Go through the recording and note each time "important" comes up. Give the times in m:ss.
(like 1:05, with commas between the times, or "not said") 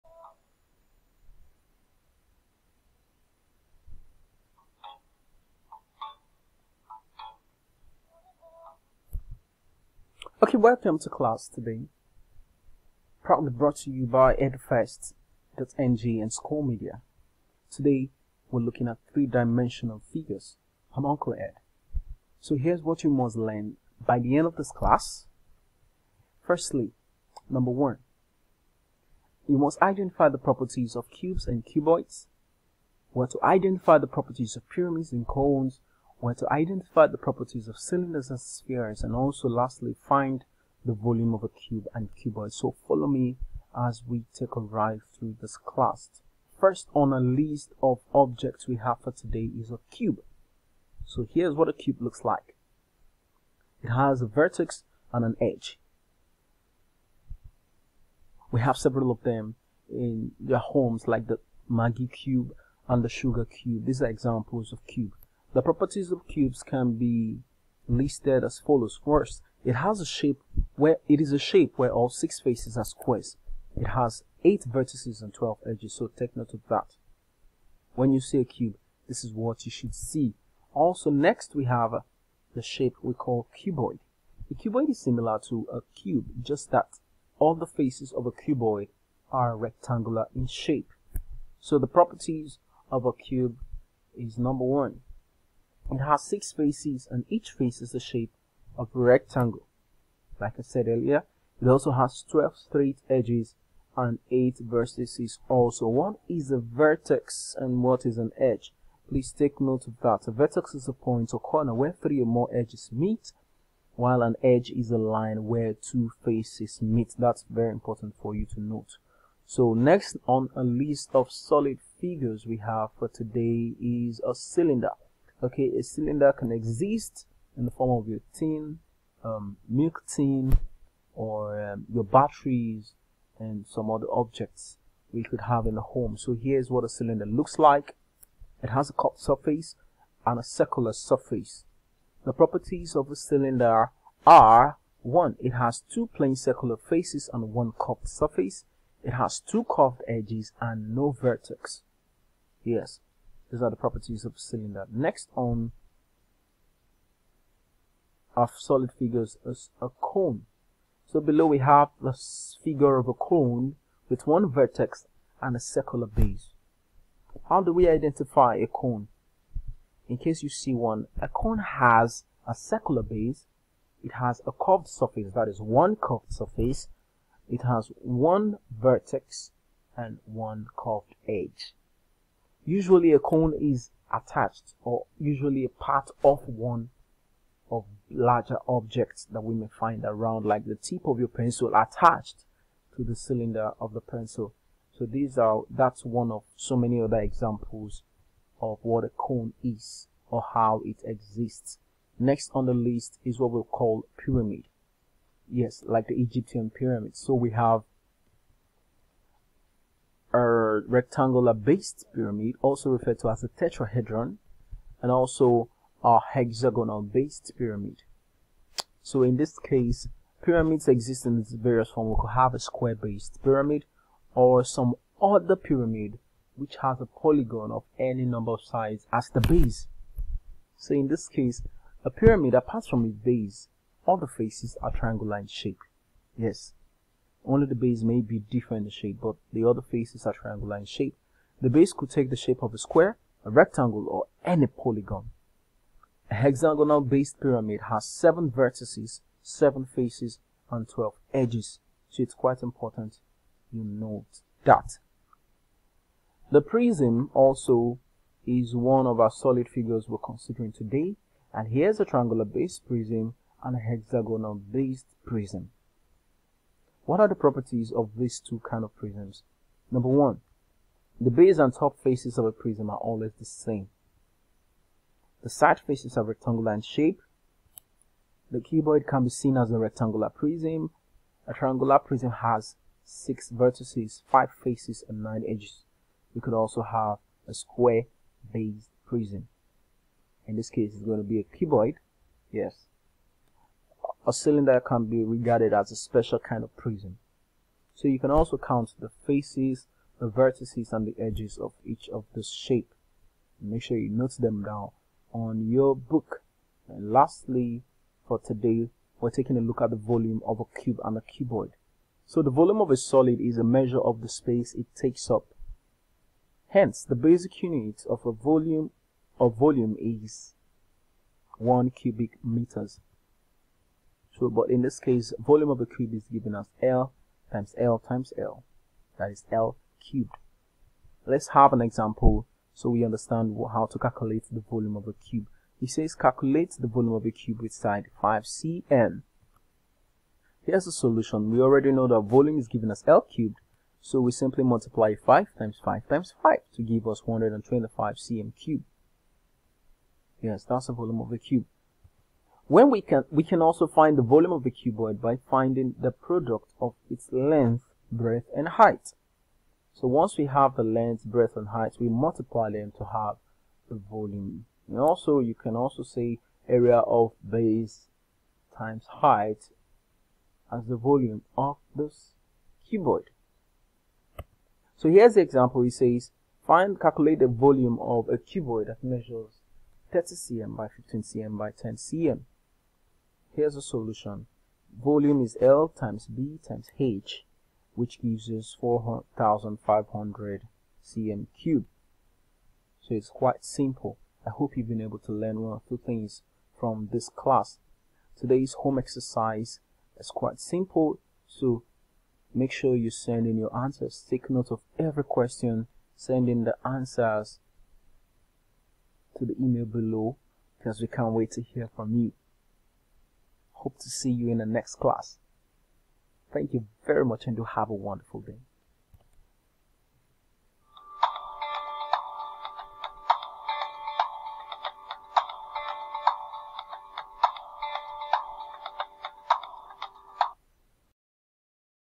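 1:57, 4:12.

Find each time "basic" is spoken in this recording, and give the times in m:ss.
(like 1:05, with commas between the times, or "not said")
5:17.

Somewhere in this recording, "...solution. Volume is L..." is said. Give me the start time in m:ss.
6:23.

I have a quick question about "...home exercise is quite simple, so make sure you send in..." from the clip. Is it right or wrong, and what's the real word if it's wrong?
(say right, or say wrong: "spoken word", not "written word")
right.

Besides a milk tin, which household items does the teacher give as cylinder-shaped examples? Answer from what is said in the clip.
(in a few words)
batteries.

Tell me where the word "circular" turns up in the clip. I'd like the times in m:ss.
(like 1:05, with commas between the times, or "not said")
2:20, 2:26, 2:45, 2:52.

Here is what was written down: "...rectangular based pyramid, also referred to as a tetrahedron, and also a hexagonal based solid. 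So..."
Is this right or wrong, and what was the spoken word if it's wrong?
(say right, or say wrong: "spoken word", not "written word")
wrong: "pyramid", not "solid".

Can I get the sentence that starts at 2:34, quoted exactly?
Next on of solid figures is a cone.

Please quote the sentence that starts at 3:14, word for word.
So these are that's one of so many other examples of what a cone is or how it exists.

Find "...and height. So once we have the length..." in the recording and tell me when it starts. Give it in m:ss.
5:58.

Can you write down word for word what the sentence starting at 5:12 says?
So the volume of a solid is a measure of the space it takes up.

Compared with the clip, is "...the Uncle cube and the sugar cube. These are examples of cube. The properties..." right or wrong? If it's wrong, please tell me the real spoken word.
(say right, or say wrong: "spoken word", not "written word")
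wrong: "Maggi", not "Uncle".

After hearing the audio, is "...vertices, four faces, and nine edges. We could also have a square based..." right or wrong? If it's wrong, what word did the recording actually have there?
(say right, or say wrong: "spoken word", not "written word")
wrong: "five", not "four".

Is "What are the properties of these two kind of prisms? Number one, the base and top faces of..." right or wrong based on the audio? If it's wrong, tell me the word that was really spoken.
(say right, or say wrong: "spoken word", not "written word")
right.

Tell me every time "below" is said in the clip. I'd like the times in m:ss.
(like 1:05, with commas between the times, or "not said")
2:41, 6:49.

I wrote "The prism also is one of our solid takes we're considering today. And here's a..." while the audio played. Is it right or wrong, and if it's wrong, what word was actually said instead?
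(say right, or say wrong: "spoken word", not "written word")
wrong: "figures", not "takes".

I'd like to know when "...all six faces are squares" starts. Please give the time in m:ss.
1:11.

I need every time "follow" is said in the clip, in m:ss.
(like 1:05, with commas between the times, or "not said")
0:42, 1:08.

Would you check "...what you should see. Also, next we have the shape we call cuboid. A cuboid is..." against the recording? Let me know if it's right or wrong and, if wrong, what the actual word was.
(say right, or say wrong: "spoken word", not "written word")
right.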